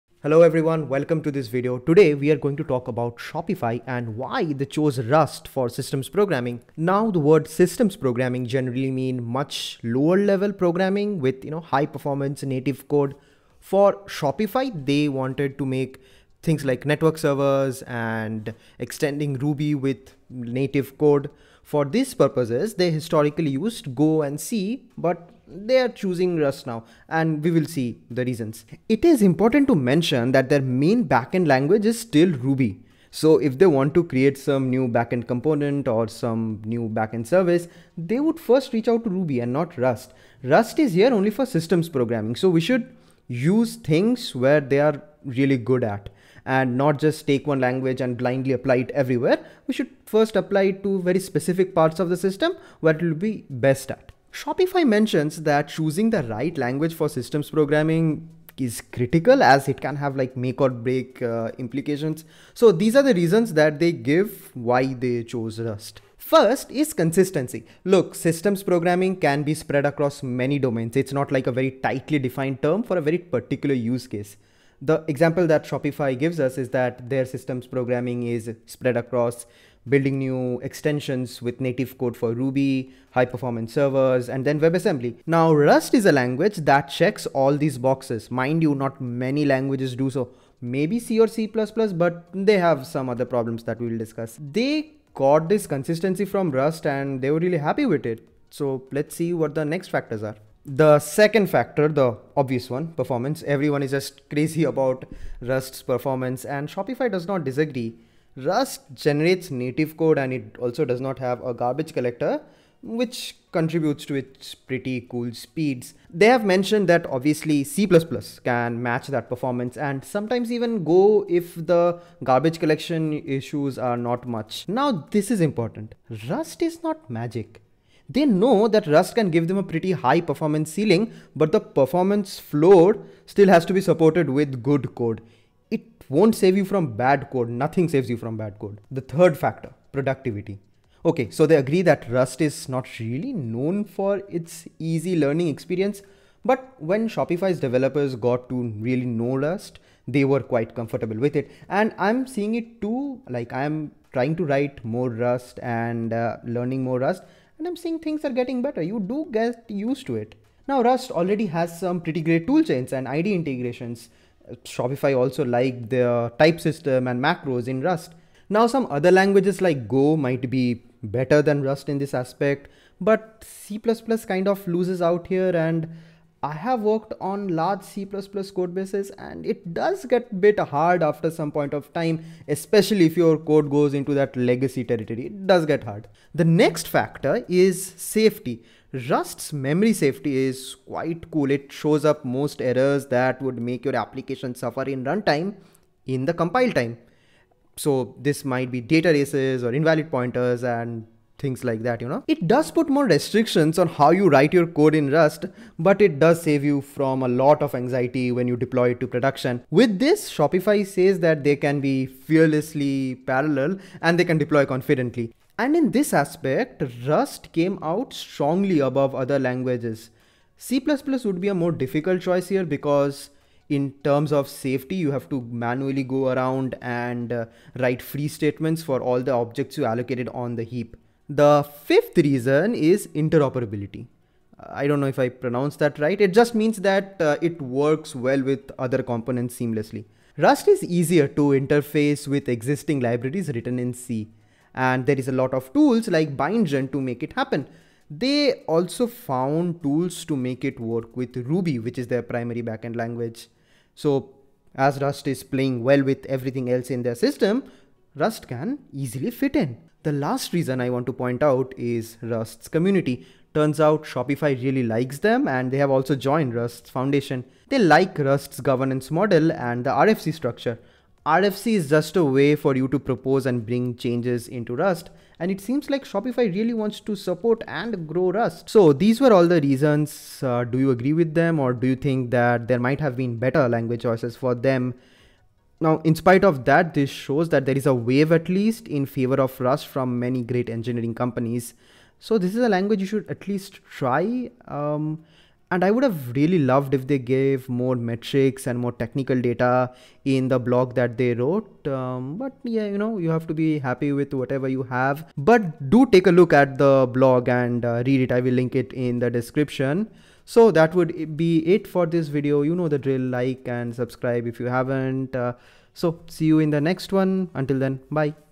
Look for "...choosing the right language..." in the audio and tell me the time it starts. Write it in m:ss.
0:55.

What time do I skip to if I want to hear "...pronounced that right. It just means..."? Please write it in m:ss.
3:55.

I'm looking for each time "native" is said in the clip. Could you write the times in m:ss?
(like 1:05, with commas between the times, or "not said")
0:12, 0:20, 1:21, 1:49.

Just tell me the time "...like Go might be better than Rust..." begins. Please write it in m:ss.
2:49.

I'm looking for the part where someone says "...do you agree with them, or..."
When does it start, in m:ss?
4:40.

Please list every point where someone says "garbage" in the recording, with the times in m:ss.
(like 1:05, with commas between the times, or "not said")
1:51, 2:02.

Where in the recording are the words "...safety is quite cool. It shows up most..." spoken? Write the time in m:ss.
3:09.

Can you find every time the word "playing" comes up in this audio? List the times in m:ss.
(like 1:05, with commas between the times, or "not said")
4:15.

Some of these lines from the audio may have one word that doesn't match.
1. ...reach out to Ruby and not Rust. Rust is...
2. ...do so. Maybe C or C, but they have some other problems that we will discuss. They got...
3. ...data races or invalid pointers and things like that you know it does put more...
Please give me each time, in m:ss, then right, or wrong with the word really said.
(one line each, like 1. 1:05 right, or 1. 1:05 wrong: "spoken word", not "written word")
1. 0:38 right
2. 1:29 right
3. 3:18 right.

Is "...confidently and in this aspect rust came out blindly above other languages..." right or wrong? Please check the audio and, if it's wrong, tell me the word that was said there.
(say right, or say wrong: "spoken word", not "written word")
wrong: "strongly", not "blindly".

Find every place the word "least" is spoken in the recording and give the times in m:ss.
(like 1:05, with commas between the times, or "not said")
4:48, 4:53.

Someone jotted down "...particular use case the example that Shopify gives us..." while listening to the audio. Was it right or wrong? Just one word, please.
right.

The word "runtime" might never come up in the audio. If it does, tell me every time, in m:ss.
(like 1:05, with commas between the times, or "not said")
3:15.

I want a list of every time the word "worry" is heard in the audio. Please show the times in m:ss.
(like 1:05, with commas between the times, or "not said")
not said.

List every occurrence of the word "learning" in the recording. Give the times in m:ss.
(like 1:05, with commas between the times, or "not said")
2:25, 2:36.